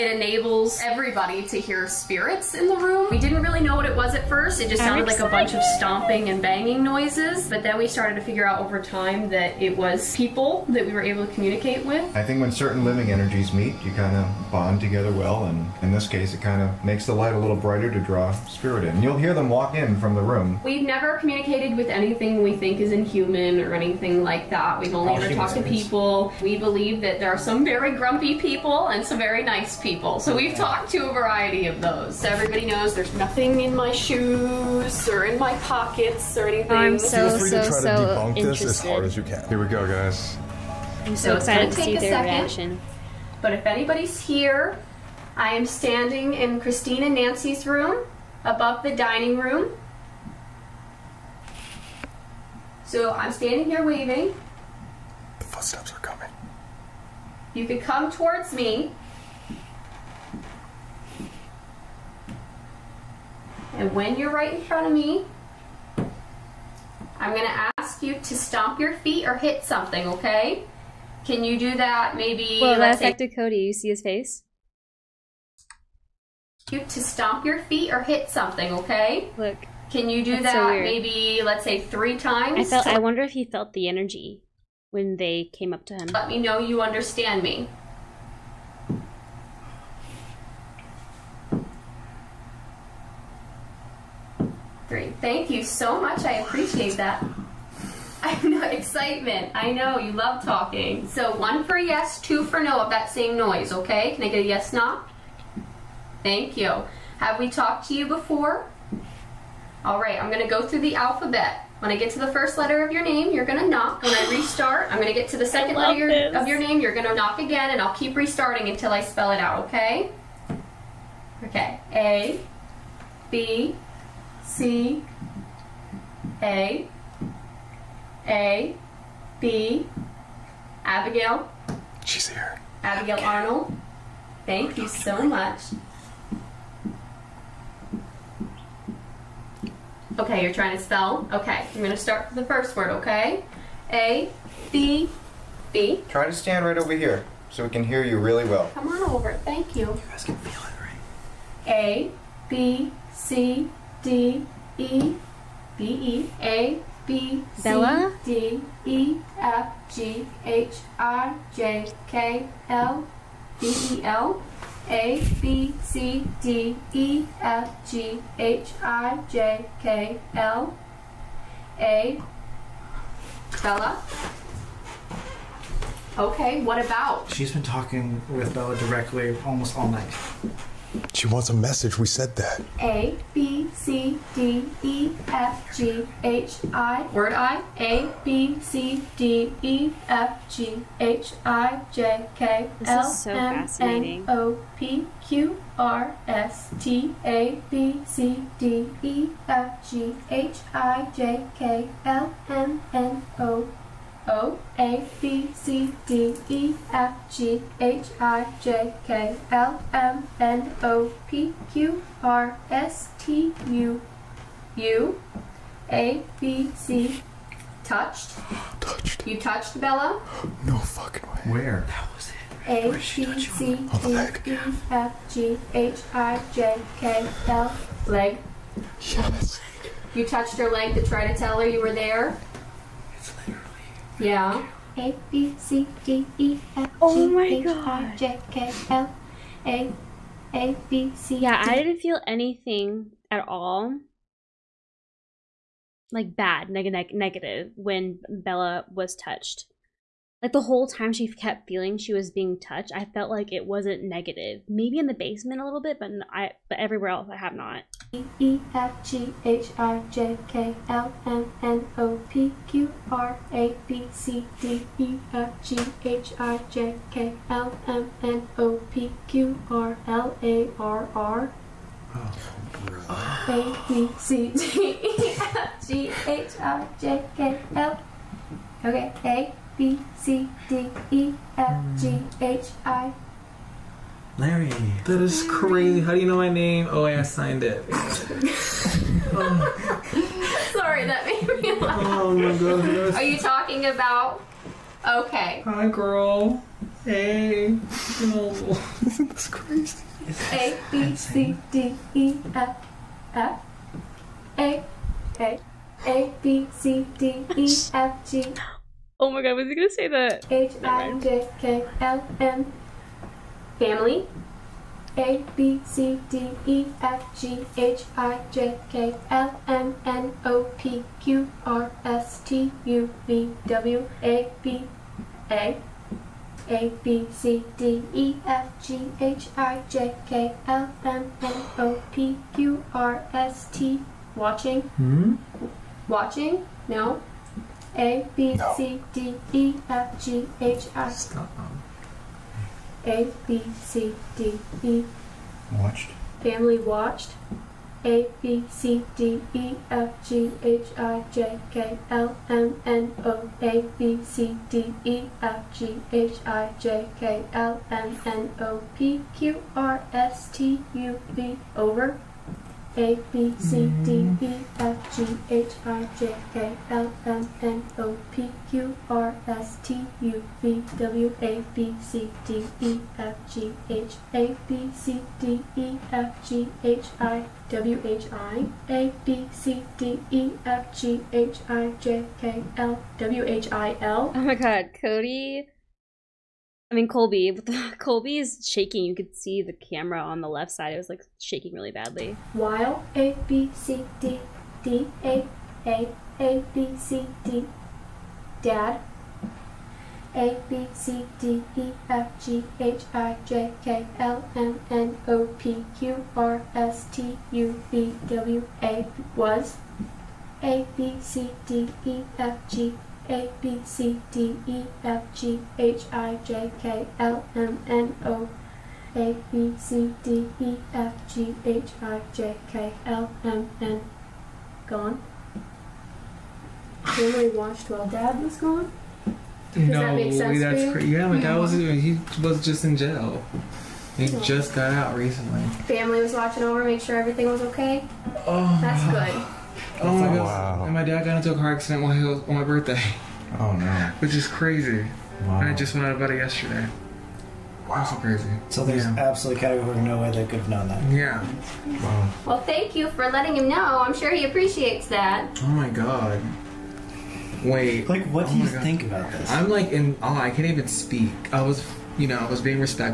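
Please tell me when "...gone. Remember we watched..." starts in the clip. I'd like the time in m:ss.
7:04.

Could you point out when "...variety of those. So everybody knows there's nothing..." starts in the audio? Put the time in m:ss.
0:31.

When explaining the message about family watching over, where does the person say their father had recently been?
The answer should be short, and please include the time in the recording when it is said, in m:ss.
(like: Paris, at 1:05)
Jail, at 7:12.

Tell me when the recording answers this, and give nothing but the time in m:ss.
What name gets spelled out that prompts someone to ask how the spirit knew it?
4:44.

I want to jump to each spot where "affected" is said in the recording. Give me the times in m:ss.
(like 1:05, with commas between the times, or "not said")
1:12.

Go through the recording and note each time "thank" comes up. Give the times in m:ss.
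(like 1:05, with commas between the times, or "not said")
1:35, 1:46, 2:14, 2:29, 7:32.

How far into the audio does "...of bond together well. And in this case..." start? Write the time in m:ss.
0:14.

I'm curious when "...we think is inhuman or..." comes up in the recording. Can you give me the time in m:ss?
0:22.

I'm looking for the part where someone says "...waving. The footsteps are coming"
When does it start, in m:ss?
0:53.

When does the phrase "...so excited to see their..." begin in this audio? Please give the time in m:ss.
0:41.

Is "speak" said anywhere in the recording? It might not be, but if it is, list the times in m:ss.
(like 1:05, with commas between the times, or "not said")
7:40.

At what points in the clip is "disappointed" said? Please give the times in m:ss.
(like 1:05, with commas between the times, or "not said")
not said.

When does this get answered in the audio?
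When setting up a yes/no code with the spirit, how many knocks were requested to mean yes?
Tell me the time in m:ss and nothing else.
1:41.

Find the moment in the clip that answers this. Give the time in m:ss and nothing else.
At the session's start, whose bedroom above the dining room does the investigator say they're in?
0:46.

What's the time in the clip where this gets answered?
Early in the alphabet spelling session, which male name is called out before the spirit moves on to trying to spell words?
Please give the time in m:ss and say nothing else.
2:13.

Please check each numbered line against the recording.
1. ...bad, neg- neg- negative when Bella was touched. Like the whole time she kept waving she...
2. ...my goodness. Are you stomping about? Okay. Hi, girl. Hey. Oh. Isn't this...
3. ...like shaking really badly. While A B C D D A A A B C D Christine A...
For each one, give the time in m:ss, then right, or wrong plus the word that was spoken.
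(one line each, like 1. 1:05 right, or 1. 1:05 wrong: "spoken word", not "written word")
1. 4:06 wrong: "feeling", not "waving"
2. 4:52 wrong: "talking", not "stomping"
3. 6:31 wrong: "Dad", not "Christine".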